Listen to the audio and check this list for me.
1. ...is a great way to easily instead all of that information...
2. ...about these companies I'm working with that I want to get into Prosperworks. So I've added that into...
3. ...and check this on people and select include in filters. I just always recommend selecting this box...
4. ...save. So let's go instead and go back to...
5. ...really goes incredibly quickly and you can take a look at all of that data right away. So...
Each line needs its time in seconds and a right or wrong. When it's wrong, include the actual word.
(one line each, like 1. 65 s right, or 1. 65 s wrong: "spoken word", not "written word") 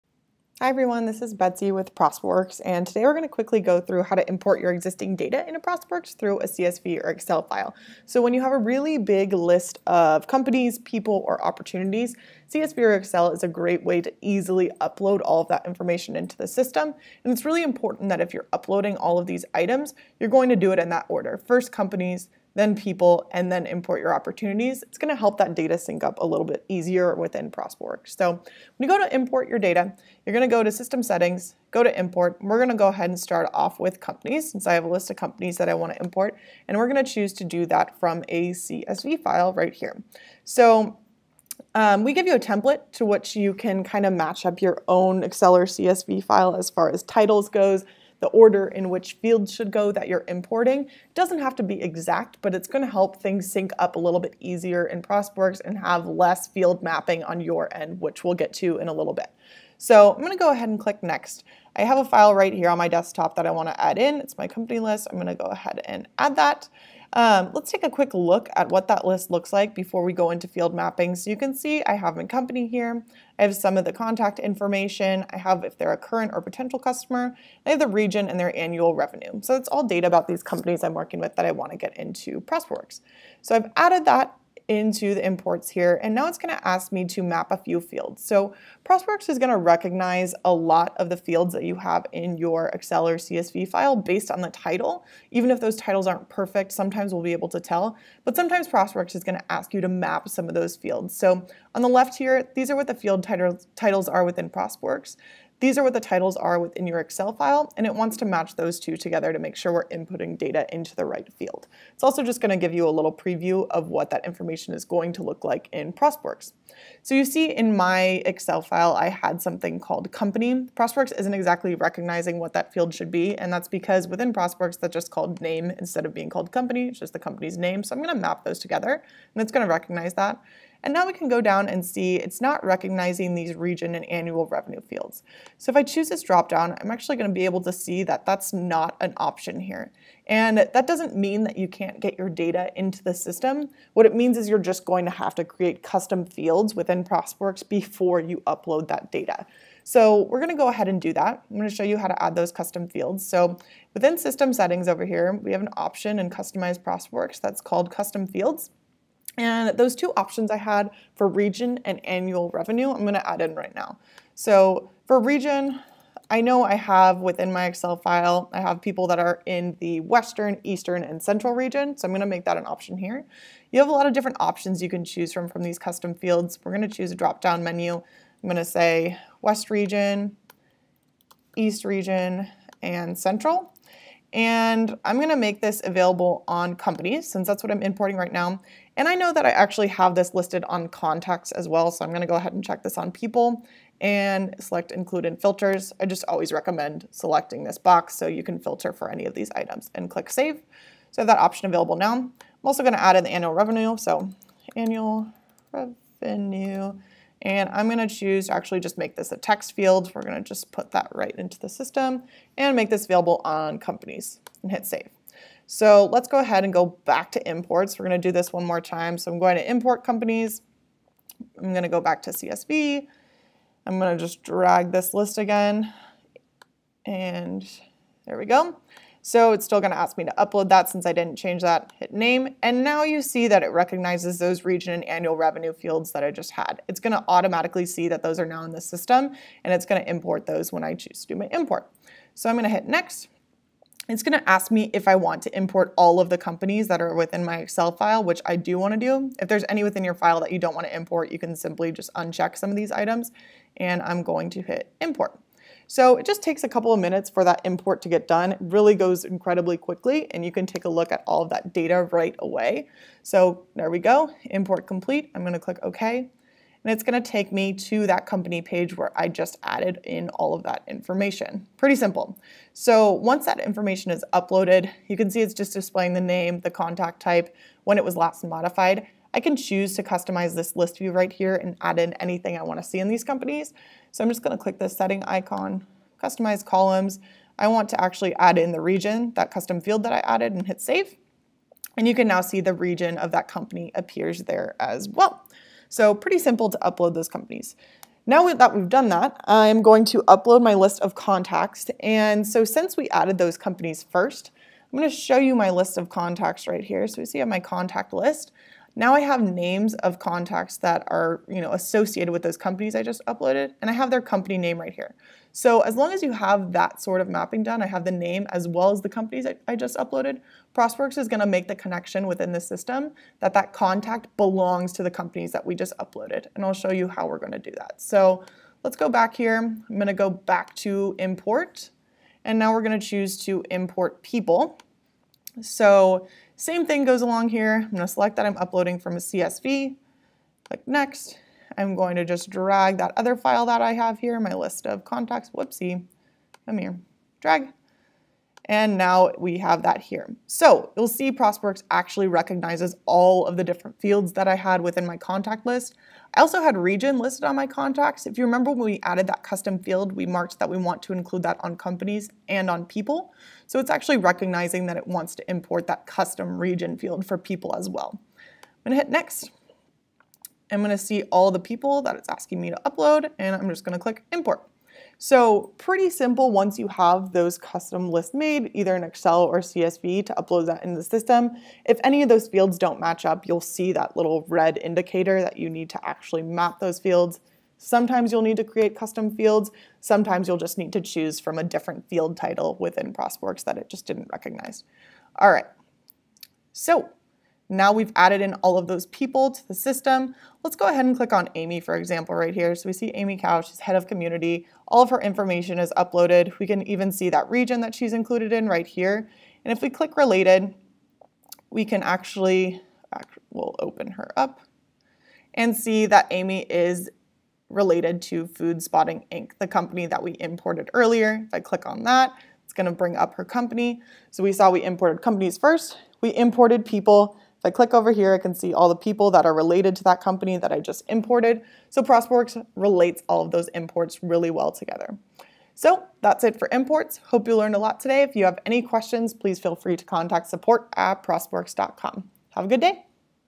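1. 13 s wrong: "upload", not "instead"
2. 80 s right
3. 192 s right
4. 214 s wrong: "ahead", not "instead"
5. 258 s right.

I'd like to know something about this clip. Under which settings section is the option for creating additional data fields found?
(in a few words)
Customize Prosperworks.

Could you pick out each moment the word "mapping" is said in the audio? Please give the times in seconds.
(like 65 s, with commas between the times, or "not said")
56 s, 70 s, 317 s.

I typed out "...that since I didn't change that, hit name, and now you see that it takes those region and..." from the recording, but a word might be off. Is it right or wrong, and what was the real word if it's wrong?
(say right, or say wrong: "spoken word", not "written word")
wrong: "recognizes", not "takes".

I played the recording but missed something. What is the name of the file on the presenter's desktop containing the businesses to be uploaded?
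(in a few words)
company list.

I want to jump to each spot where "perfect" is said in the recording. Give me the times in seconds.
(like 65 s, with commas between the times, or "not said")
96 s.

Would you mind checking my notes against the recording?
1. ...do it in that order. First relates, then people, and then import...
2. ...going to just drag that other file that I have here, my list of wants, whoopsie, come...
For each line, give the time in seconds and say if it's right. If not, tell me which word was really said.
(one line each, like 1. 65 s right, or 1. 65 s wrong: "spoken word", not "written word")
1. 20 s wrong: "companies", not "relates"
2. 341 s wrong: "contacts", not "wants".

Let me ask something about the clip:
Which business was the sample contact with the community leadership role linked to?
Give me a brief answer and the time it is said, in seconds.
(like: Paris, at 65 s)
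Food Spotting Inc., at 418 s.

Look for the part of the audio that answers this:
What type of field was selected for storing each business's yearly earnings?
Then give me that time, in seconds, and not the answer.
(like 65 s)
209 s.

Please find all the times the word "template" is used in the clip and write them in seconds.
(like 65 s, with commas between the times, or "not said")
42 s.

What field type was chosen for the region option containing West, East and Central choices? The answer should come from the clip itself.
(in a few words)
drop-down menu.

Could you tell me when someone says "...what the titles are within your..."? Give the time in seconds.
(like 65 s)
105 s.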